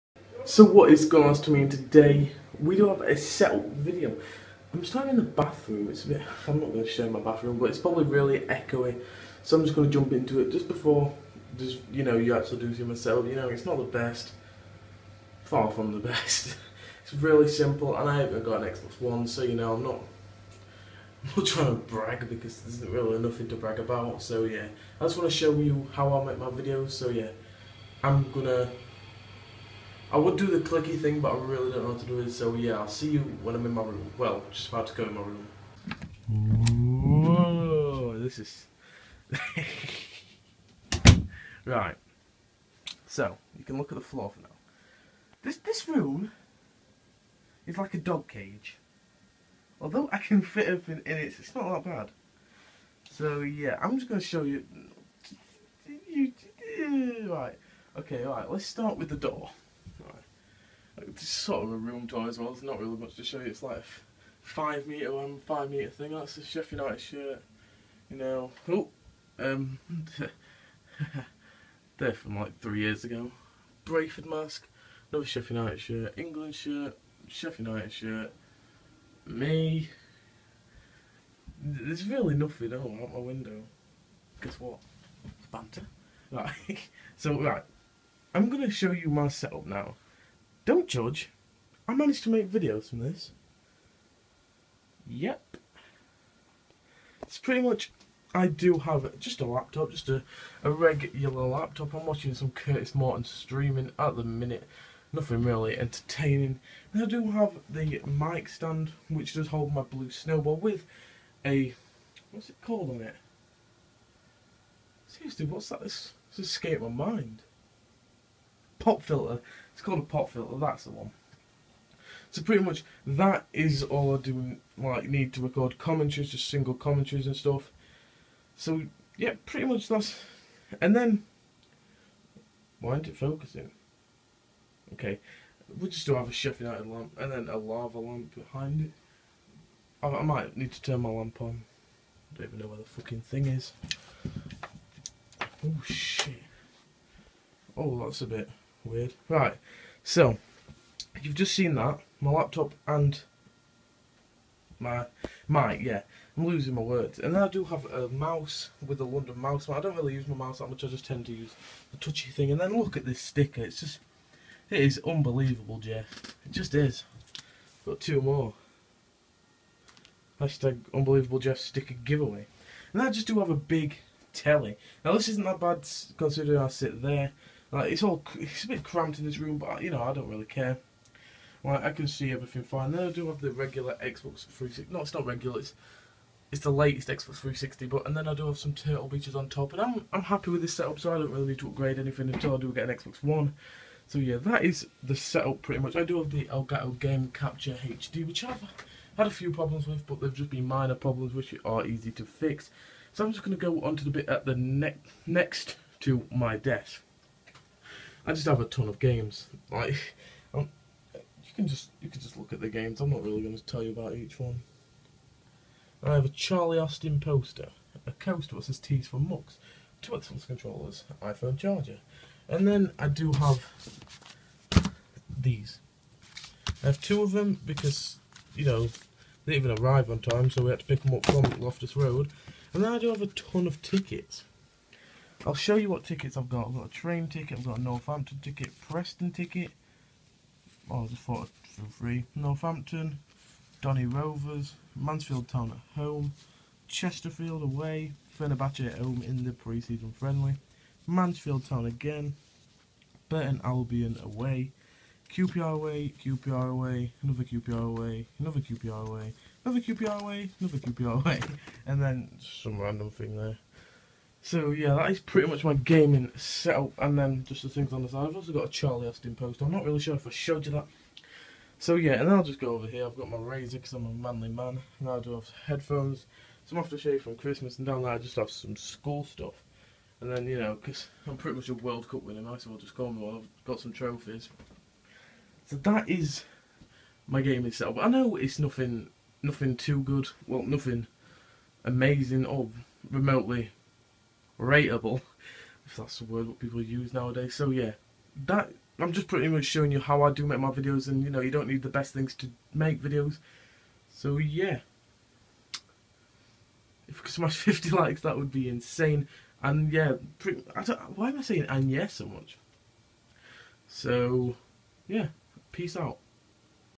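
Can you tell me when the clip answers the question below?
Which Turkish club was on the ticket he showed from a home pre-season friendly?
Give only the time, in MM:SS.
04:08.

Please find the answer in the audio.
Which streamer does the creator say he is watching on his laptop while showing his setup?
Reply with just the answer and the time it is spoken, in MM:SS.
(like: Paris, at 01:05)
Curtis Morton, at 01:42.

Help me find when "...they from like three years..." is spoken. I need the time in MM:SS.
01:11.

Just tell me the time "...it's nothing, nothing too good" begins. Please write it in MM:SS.
04:48.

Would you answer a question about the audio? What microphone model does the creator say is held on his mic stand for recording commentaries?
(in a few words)
Blue Snowball.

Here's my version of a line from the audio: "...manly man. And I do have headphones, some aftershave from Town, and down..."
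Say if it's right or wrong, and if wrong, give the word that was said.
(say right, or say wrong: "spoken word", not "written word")
wrong: "Christmas", not "Town".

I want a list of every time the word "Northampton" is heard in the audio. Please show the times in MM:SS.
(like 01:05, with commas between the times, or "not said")
03:57, 04:02.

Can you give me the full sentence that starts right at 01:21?
There's really nothing out my window.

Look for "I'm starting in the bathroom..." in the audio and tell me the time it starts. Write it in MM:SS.
00:04.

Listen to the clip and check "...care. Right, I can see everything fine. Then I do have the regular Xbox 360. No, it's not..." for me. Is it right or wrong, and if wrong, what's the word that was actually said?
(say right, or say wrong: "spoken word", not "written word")
right.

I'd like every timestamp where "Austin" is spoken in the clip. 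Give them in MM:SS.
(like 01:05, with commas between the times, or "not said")
03:36, 04:29.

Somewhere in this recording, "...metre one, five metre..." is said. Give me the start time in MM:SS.
01:04.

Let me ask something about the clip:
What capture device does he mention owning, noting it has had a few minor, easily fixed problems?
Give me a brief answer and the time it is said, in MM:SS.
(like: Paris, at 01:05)
Elgato Game Capture HD, at 03:16.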